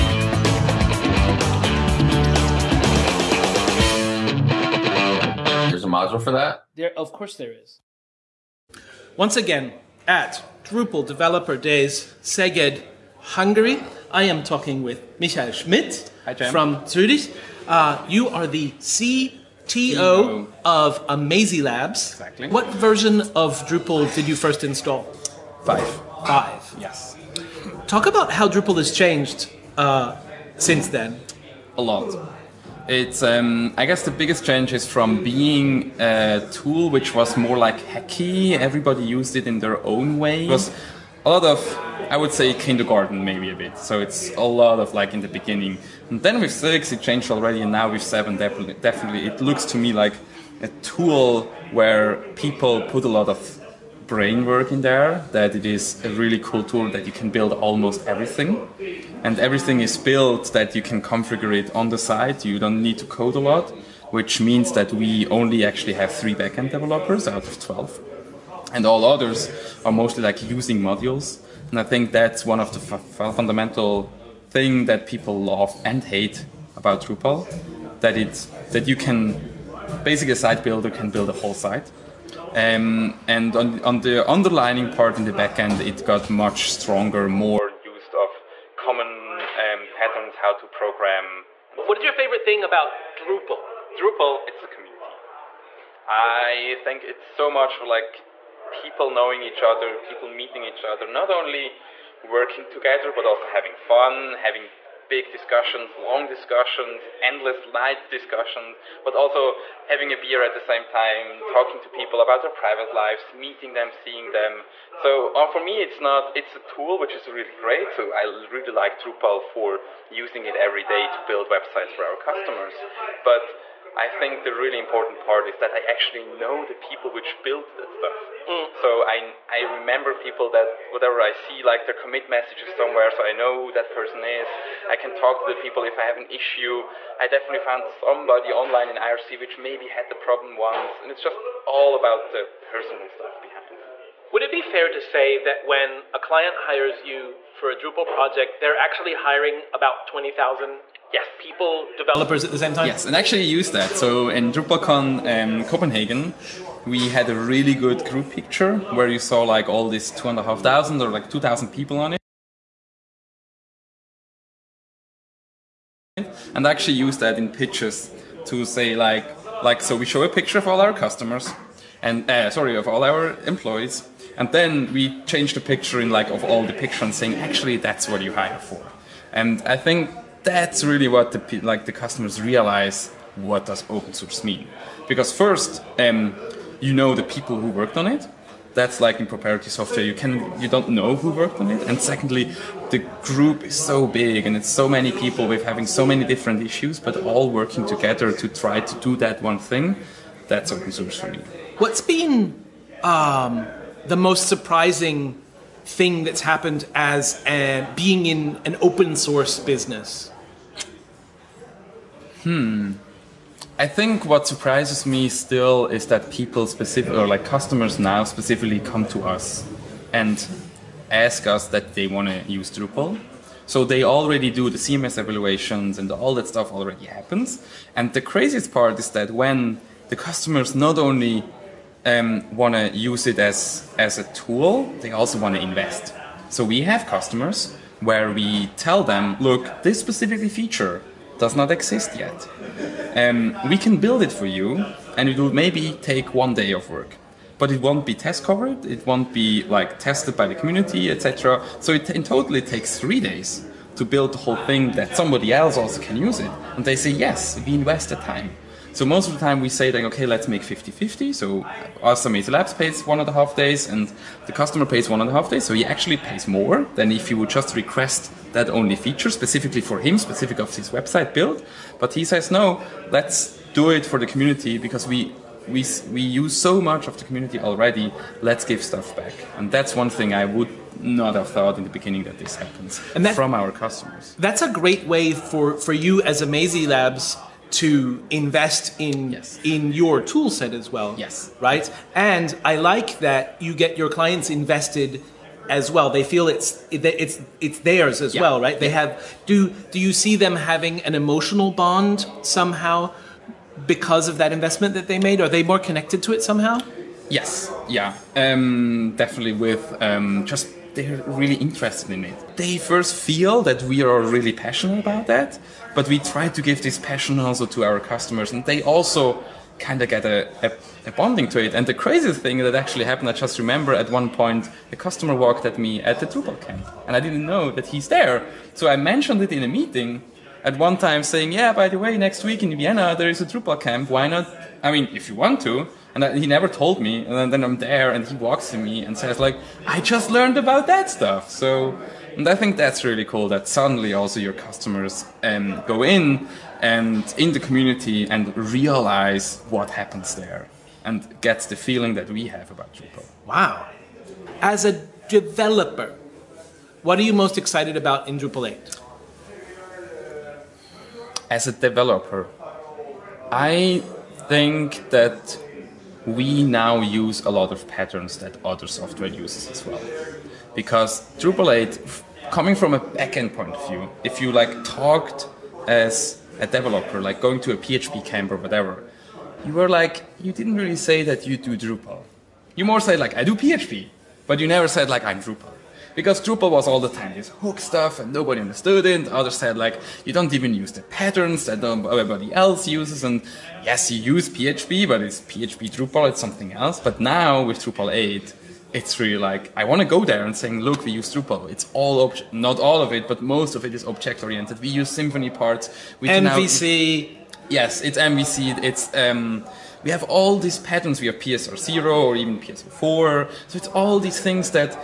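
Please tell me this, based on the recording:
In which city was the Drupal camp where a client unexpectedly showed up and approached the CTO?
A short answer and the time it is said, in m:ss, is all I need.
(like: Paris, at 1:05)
Vienna, at 5:32.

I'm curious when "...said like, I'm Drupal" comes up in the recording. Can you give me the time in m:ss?
6:24.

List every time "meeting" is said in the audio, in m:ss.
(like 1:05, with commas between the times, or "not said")
1:40, 1:53, 5:29.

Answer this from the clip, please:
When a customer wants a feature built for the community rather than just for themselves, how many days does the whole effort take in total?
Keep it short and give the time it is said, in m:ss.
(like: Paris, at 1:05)
3, at 4:12.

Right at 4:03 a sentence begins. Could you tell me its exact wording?
Um, we can build it for you, and it will maybe take one day of work.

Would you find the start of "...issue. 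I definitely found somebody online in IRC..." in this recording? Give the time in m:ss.
2:16.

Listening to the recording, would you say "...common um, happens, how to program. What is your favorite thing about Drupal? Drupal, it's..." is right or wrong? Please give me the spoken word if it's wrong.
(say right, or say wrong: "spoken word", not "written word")
wrong: "patterns", not "happens".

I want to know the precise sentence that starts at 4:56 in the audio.
They feel it's it's it's theirs as yeah.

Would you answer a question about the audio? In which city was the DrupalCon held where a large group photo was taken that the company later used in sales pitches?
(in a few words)
Copenhagen.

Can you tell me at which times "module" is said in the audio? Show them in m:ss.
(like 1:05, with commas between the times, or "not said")
0:05, 1:10.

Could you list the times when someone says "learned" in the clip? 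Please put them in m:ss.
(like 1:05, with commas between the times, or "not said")
5:40.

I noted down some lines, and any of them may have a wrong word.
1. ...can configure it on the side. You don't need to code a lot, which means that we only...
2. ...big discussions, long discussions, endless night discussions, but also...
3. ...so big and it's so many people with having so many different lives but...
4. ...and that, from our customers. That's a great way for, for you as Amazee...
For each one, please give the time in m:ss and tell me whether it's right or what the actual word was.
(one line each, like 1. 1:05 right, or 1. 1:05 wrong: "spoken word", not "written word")
1. 1:00 right
2. 1:45 right
3. 3:13 wrong: "issues", not "lives"
4. 4:43 right.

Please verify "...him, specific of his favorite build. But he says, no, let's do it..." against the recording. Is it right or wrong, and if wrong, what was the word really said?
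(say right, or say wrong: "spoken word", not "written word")
wrong: "website", not "favorite".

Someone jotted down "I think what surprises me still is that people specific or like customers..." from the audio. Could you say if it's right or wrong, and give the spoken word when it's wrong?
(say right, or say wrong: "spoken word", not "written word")
right.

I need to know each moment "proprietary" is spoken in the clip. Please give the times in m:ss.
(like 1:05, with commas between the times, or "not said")
3:09.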